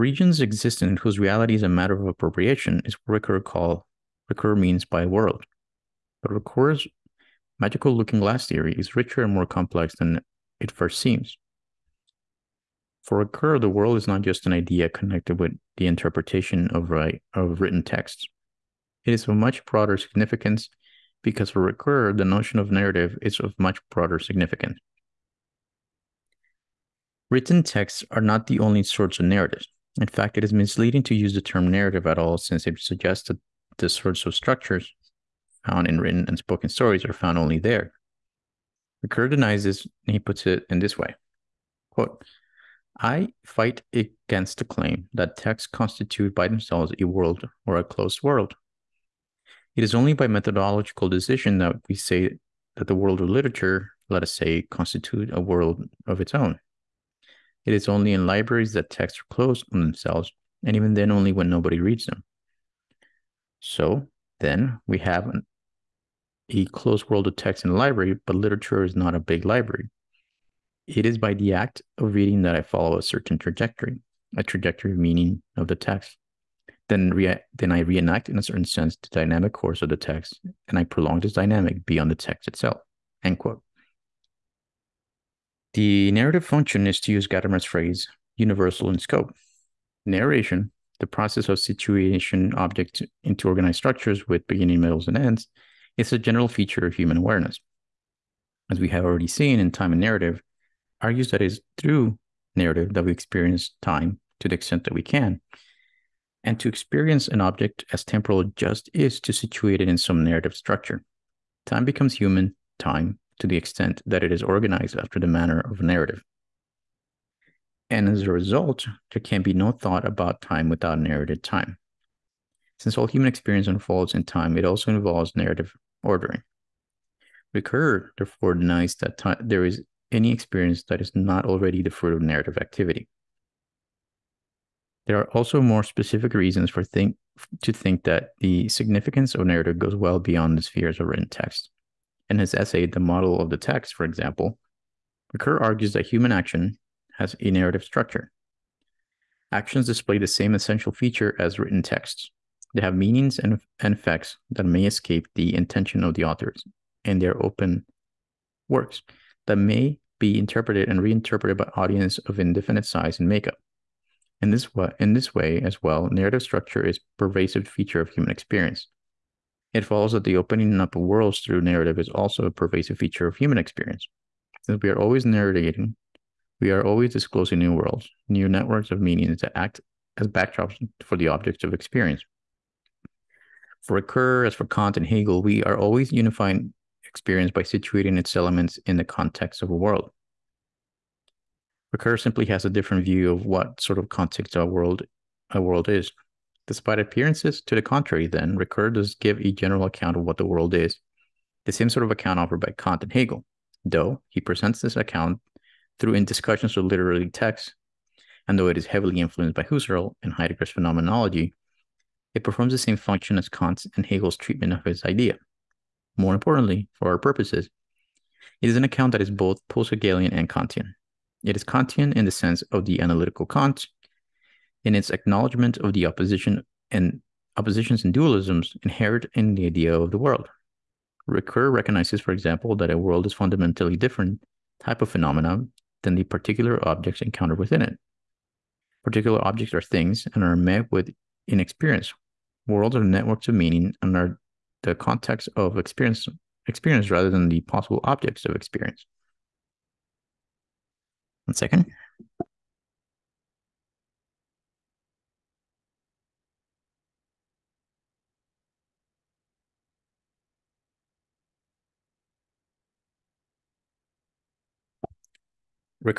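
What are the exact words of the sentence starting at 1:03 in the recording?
So then we have an, a closed world of texts in a library, but literature is not a big library.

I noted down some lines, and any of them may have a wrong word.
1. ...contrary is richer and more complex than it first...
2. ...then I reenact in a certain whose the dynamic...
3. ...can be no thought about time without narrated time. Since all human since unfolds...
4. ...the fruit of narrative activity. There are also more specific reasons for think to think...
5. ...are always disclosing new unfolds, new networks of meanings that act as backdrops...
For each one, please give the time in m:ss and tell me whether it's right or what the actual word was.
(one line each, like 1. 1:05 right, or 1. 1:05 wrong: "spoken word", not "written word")
1. 0:08 wrong: "theory", not "contrary"
2. 1:17 wrong: "sense", not "whose"
3. 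1:59 wrong: "experience", not "since"
4. 2:11 right
5. 2:56 wrong: "worlds", not "unfolds".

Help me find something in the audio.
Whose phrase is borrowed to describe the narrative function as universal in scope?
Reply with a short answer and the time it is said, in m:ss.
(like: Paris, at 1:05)
Gadamer, at 1:27.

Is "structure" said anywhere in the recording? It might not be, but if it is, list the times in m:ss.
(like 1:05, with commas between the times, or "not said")
0:34, 1:33, 1:50, 2:27, 2:46.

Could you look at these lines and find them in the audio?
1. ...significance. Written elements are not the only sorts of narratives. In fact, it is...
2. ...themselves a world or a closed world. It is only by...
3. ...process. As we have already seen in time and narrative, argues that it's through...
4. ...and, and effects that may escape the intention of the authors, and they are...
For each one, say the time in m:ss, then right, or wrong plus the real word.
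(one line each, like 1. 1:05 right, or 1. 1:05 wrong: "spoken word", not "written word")
1. 0:24 wrong: "texts", not "elements"
2. 0:46 right
3. 1:37 wrong: "awareness", not "process"
4. 2:33 right.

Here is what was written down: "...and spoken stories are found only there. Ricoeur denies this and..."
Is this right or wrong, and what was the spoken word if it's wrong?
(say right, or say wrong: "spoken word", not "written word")
right.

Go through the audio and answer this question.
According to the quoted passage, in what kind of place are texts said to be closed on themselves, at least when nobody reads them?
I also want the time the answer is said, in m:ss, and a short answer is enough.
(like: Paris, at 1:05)
libraries, at 0:58.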